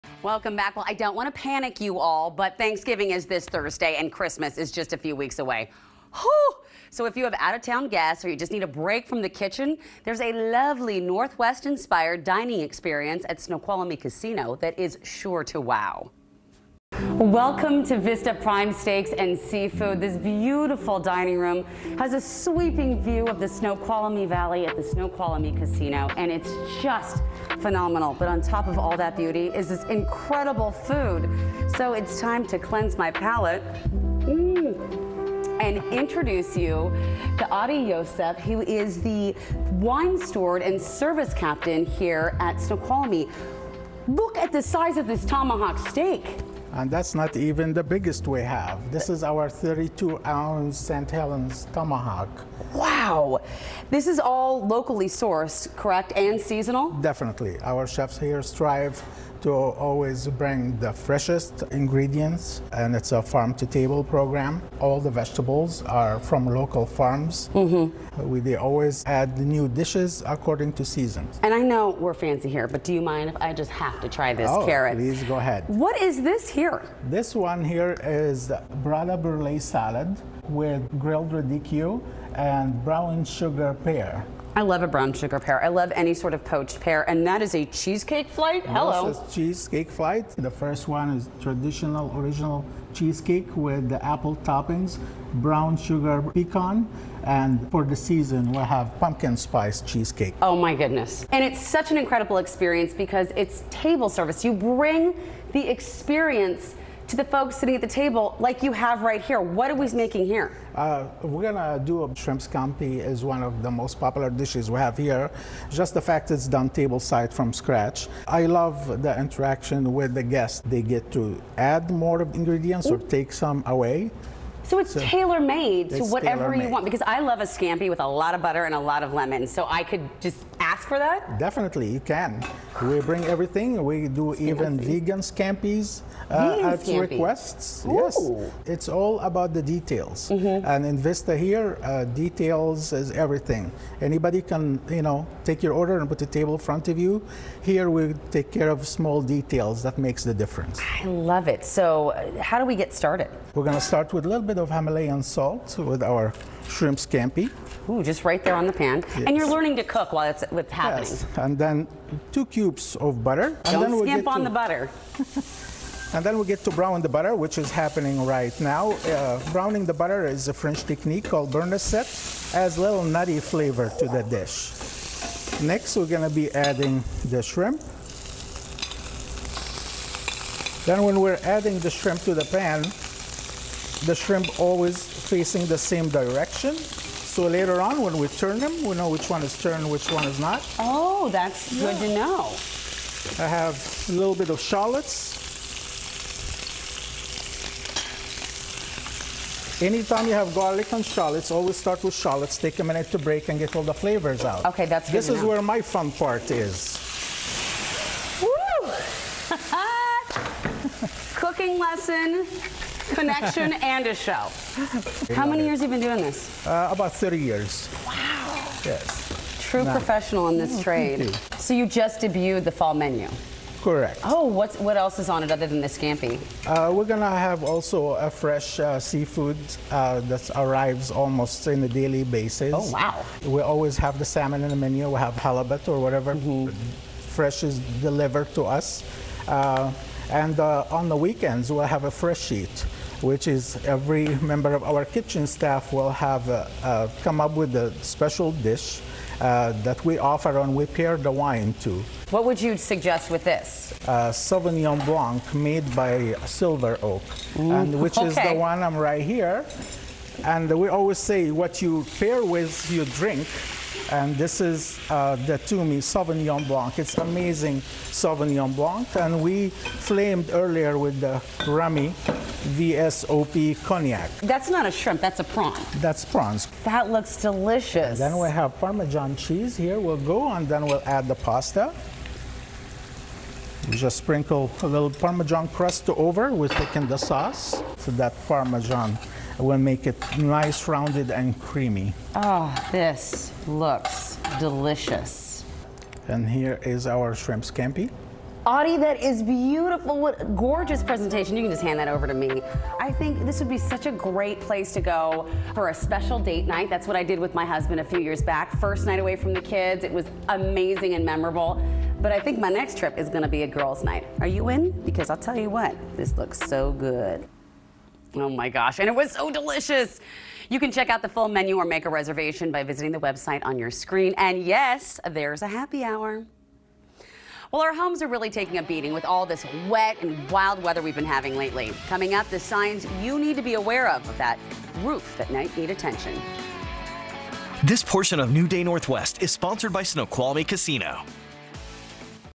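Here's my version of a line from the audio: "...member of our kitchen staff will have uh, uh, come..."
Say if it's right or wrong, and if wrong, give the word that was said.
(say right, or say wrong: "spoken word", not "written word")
right.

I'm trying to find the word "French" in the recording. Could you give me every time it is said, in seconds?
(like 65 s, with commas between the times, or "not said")
170 s.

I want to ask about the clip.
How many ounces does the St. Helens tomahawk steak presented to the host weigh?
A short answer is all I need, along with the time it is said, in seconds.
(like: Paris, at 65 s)
32, at 49 s.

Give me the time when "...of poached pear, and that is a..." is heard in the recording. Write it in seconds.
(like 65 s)
86 s.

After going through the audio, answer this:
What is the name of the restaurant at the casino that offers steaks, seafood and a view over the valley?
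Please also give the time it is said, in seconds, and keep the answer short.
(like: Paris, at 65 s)
Vista Prime Steaks and Seafood, at 17 s.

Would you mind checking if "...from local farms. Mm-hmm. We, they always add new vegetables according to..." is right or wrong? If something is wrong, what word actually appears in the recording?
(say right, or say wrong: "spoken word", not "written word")
wrong: "dishes", not "vegetables".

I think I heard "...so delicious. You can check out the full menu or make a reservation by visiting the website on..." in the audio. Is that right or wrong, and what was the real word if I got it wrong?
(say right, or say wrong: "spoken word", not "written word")
right.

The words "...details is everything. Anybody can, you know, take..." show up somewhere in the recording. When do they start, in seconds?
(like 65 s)
142 s.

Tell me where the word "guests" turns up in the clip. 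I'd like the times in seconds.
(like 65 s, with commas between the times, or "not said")
7 s, 120 s.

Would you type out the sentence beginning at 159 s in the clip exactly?
And you're learning to cook while it's with happening.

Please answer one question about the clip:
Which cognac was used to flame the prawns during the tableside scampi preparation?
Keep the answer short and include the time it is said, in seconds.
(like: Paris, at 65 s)
Remy VSOP, at 271 s.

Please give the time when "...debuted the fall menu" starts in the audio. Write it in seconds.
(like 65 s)
222 s.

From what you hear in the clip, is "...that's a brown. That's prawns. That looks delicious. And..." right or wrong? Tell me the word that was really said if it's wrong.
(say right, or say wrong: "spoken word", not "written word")
wrong: "prawn", not "brown".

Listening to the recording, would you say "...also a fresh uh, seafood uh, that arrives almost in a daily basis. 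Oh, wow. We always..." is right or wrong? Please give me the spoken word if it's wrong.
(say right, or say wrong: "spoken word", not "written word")
right.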